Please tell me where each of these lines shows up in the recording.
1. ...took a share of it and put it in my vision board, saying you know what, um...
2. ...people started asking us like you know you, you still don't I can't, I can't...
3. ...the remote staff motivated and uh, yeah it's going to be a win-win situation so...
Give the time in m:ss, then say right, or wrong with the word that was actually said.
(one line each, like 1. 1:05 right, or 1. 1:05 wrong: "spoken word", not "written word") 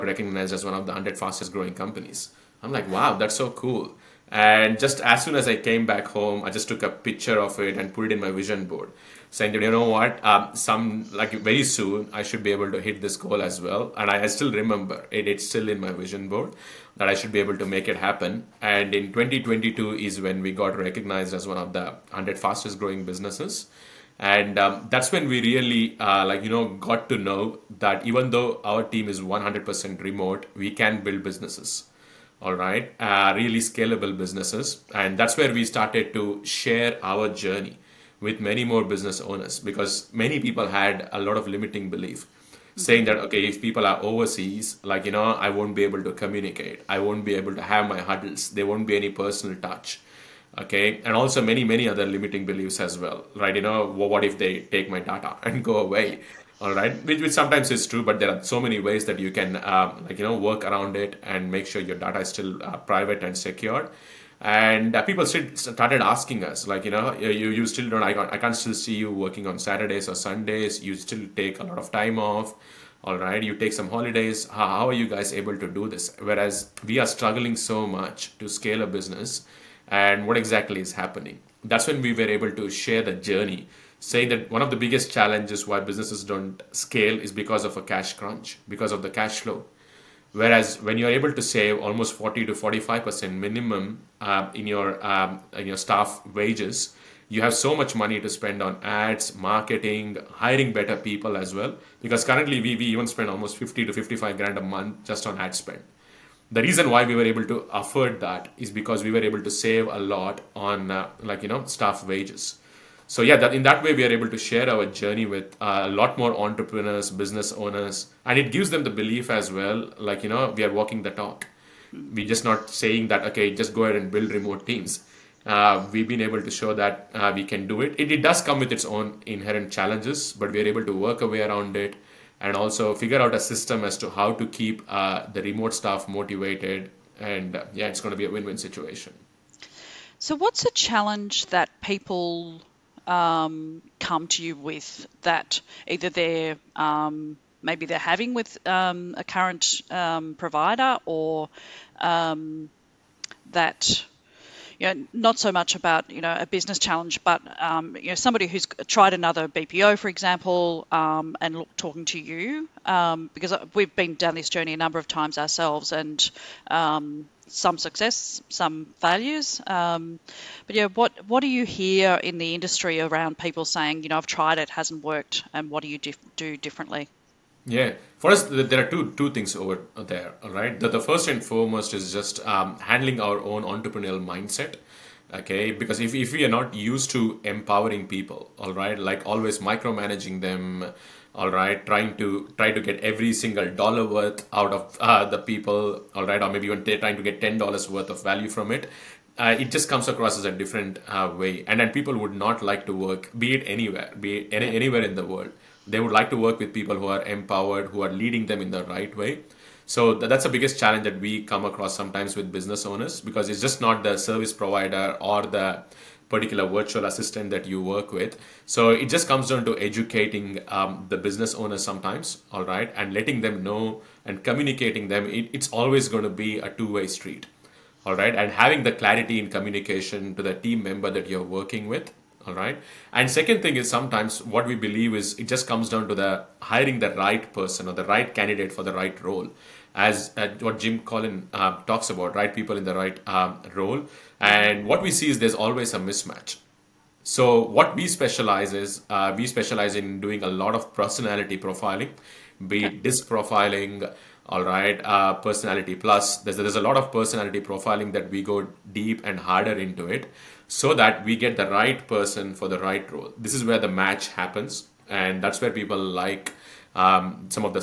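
1. 0:06 wrong: "picture", not "share"
2. 1:05 right
3. 2:15 right.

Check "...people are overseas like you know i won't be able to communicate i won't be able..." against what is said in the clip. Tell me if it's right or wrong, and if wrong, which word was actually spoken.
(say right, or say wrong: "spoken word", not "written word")
right.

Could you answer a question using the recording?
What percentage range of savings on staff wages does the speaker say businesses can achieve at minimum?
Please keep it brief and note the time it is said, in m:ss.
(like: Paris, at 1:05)
40 to 45%, at 1:32.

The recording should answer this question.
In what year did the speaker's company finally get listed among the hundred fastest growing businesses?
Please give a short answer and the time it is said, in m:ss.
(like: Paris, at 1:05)
2022, at 0:19.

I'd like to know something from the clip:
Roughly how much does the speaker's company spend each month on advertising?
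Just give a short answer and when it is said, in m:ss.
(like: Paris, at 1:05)
50 to 55 grand, at 1:43.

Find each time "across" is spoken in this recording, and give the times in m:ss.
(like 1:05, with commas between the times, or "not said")
3:20, 3:31.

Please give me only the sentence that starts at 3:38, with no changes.
So it just comes down to educating um, the business owner sometimes, all right, and letting them know and communicating them.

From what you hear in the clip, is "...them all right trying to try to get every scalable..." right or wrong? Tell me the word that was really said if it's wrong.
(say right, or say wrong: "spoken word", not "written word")
wrong: "single", not "scalable".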